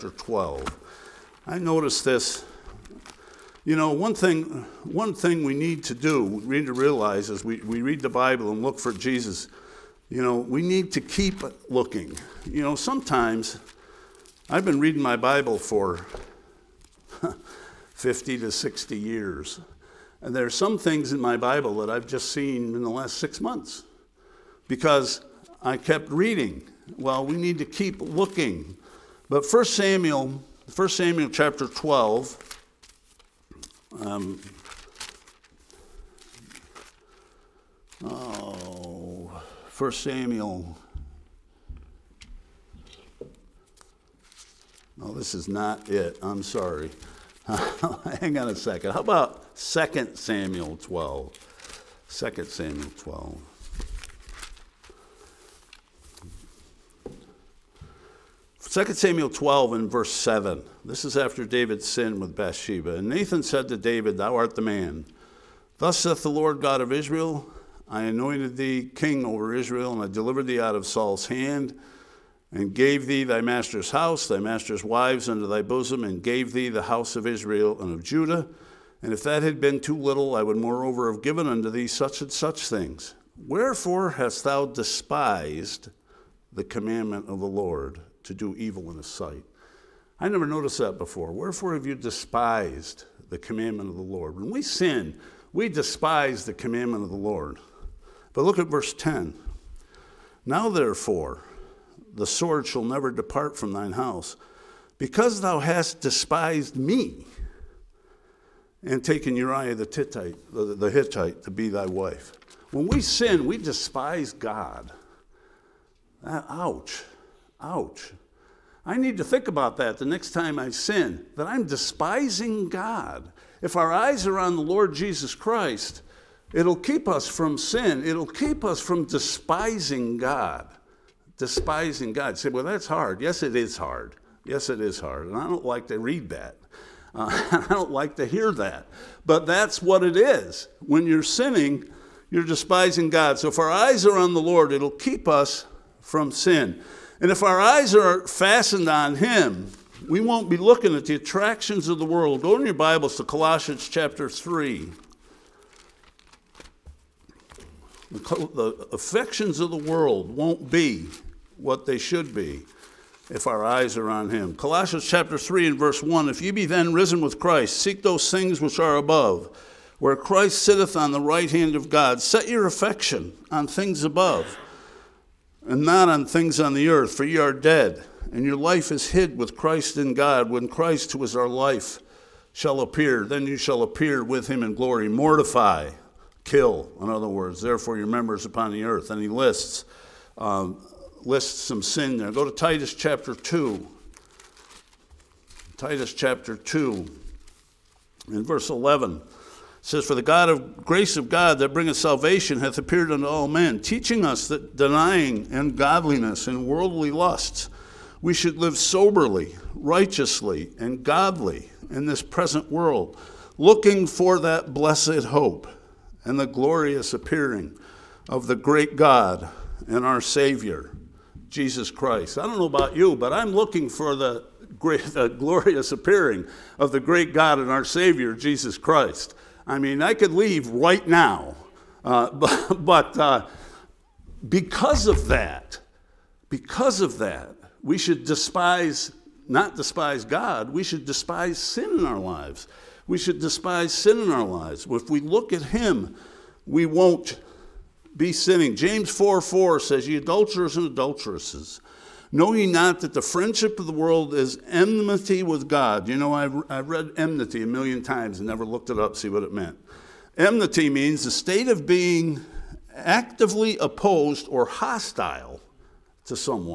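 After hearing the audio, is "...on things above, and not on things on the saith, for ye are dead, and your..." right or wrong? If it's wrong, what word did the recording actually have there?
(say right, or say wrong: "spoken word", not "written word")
wrong: "earth", not "saith".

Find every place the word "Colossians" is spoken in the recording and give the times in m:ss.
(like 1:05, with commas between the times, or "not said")
2:33, 2:44.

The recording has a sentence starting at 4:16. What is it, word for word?
You know, I've, I've read enmity a million times and never looked it up, see what it meant.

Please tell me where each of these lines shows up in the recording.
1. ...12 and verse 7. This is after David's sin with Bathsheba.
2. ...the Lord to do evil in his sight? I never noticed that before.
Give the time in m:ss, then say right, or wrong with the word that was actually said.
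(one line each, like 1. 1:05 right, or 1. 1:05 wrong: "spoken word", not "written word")
1. 0:59 right
2. 1:27 right.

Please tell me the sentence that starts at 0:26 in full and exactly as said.
Well, we need to keep looking.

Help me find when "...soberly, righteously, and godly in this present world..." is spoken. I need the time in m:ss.
3:28.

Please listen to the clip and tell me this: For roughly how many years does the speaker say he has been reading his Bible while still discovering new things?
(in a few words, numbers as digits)
50 to 60.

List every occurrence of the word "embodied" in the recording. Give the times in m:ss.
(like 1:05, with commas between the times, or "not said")
not said.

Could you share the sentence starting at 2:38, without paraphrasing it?
The affections of the world won't be what they should be if our eyes are on him.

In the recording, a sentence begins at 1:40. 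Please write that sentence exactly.
Now, therefore, the sword shall never depart from thine house.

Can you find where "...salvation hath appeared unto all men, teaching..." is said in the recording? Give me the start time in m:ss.
3:21.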